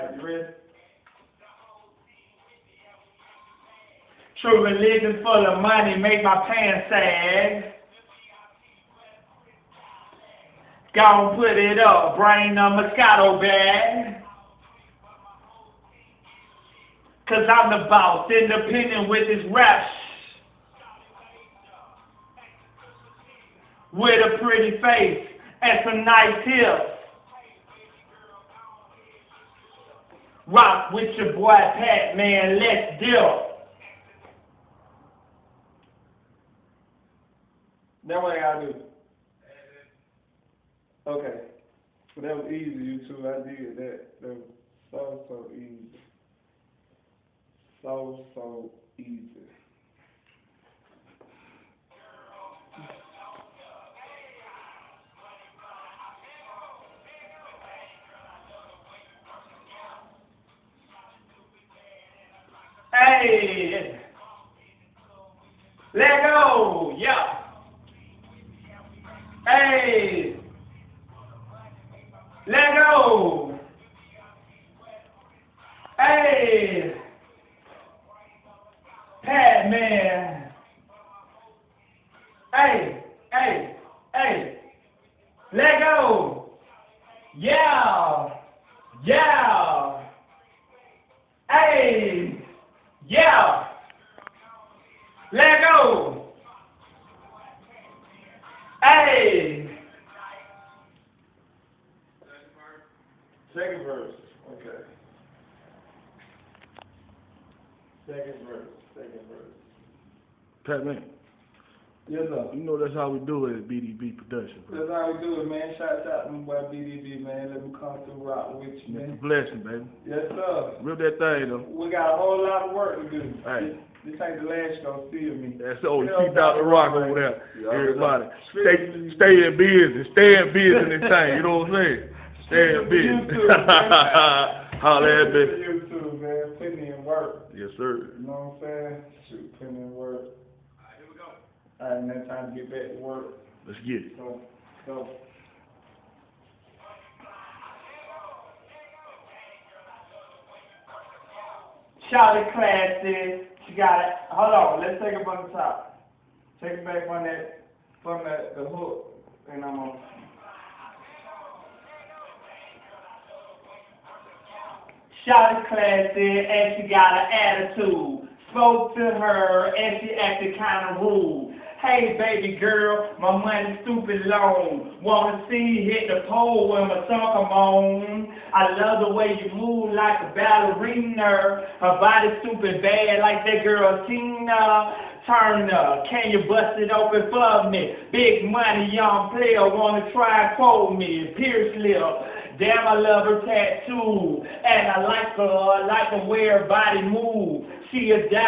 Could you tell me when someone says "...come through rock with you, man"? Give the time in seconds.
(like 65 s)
117 s.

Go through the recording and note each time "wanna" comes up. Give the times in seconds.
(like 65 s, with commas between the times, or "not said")
175 s, 189 s.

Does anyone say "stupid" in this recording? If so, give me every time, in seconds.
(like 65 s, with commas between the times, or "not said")
173 s, 182 s.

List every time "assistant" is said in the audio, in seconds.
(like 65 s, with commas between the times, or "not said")
not said.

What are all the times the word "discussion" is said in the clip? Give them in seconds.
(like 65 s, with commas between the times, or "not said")
not said.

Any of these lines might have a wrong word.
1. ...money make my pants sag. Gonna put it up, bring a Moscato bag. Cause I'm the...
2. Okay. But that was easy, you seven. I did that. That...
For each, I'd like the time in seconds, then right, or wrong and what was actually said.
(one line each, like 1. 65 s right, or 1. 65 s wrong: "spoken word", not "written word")
1. 5 s right
2. 41 s wrong: "two", not "seven".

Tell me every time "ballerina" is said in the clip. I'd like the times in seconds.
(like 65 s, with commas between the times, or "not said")
180 s.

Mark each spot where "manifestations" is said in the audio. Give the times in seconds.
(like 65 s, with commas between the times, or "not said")
not said.